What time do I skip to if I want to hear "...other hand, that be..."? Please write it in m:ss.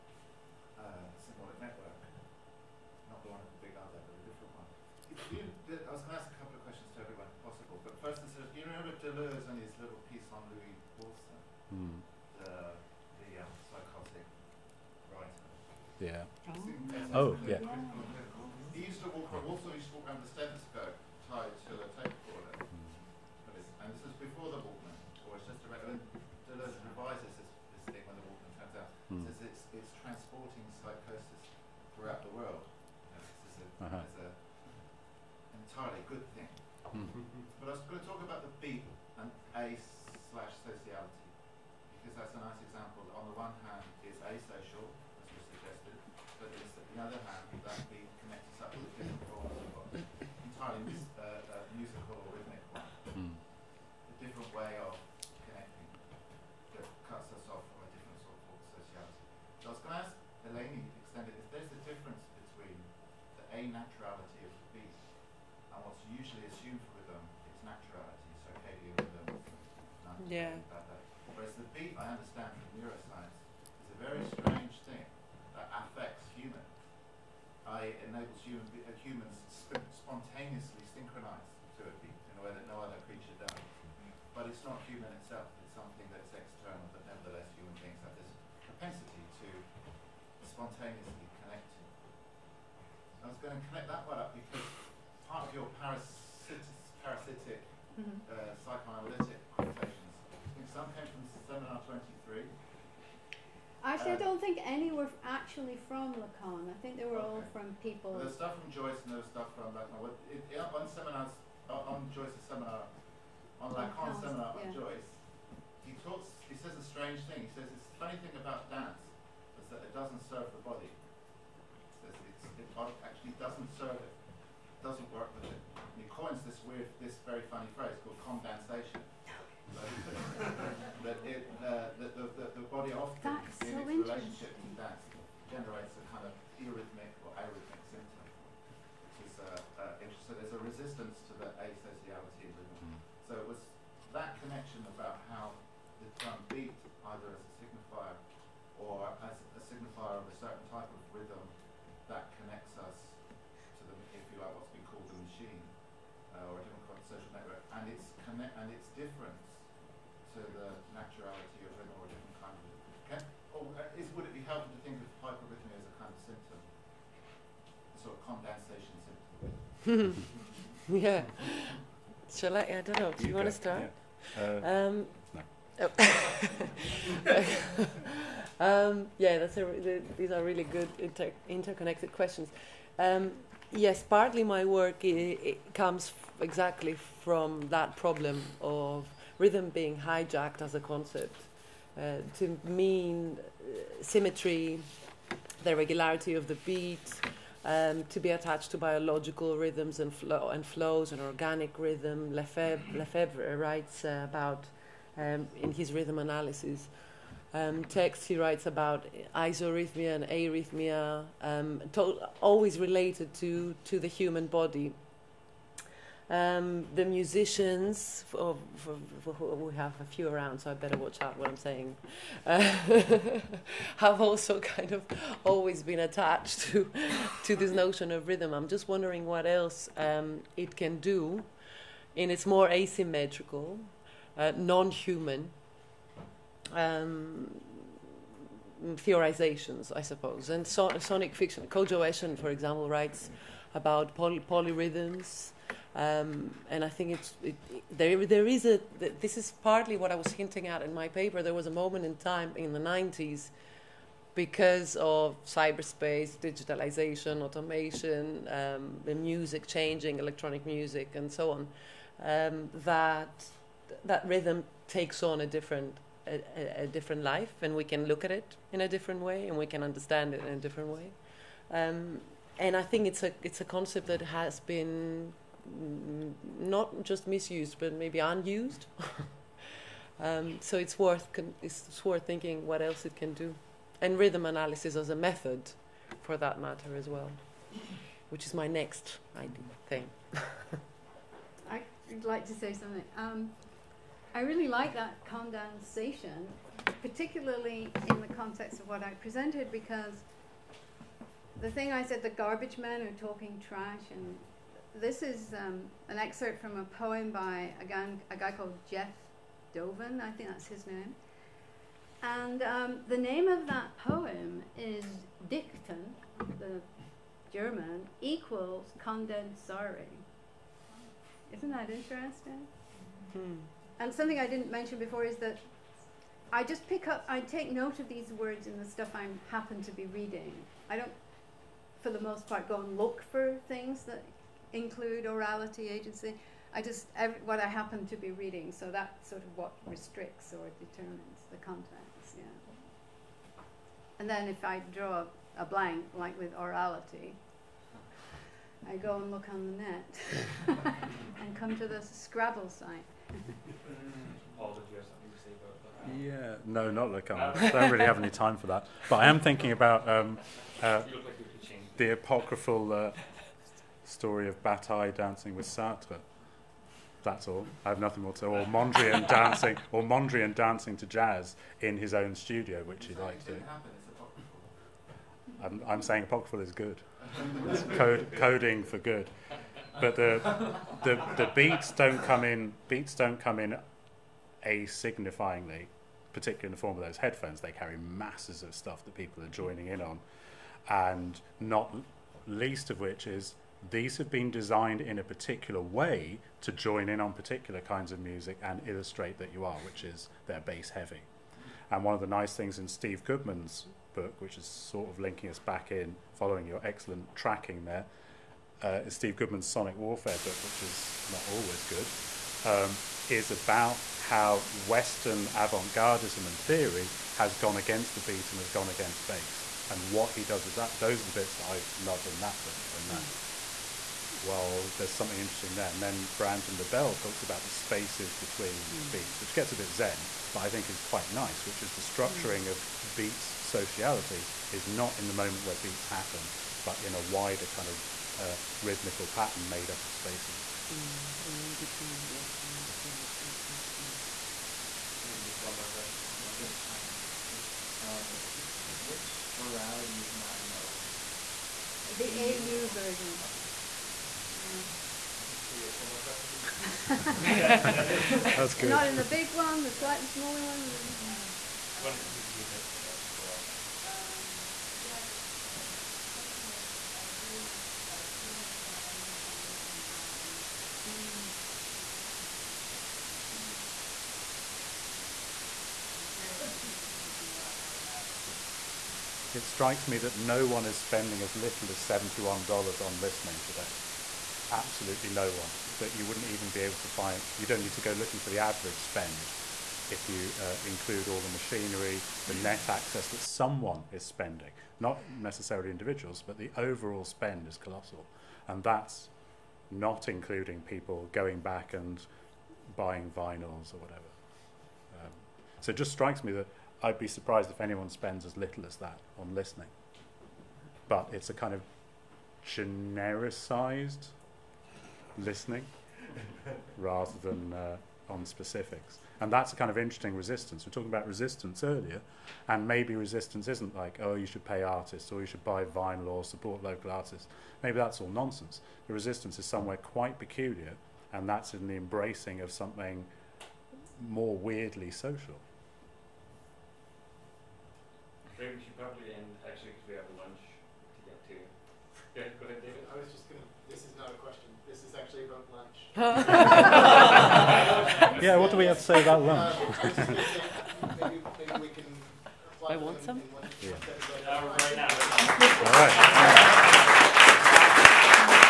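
0:47.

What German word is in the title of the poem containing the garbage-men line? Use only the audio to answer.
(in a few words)
Dichten.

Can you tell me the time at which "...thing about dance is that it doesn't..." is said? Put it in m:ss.
1:58.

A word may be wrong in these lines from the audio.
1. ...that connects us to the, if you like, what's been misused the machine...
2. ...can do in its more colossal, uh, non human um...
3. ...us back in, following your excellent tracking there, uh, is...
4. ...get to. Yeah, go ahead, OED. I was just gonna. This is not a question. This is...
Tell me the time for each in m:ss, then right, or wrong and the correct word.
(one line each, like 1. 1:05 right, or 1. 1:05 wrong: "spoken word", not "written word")
1. 2:32 wrong: "called", not "misused"
2. 3:50 wrong: "asymmetrical", not "colossal"
3. 6:45 right
4. 9:01 wrong: "David", not "OED".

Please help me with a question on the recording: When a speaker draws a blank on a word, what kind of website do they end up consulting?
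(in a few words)
Scrabble site.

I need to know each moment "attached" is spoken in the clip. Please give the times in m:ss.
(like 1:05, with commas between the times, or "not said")
3:18, 3:46.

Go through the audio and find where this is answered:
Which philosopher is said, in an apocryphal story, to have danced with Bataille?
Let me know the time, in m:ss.
6:05.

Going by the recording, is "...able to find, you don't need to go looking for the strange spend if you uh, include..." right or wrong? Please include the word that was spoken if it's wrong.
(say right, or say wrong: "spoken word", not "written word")
wrong: "average", not "strange".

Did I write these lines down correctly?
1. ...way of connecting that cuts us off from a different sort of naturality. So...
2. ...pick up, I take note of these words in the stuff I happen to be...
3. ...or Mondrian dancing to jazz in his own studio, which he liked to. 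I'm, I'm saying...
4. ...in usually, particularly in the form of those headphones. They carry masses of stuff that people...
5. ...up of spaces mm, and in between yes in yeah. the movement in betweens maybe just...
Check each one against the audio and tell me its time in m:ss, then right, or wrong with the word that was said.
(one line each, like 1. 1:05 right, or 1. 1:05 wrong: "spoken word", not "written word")
1. 0:54 wrong: "sociality", not "naturality"
2. 5:26 right
3. 6:09 right
4. 6:23 wrong: "asignifyingly", not "usually"
5. 7:19 wrong: "unsent", not "movement".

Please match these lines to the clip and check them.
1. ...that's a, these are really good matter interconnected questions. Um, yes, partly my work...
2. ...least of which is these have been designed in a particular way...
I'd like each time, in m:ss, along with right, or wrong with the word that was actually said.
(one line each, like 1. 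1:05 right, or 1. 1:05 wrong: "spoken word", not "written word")
1. 2:59 wrong: "inter", not "matter"
2. 6:32 right.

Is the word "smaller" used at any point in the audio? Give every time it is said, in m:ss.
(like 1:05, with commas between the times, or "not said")
7:40.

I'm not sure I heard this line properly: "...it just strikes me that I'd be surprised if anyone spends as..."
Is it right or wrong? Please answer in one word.
right.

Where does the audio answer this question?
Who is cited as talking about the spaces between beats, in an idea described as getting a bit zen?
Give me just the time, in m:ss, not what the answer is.
7:06.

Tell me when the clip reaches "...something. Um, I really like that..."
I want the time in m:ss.
4:52.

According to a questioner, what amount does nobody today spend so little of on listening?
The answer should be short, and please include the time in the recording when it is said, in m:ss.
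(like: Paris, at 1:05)
$71, at 8:01.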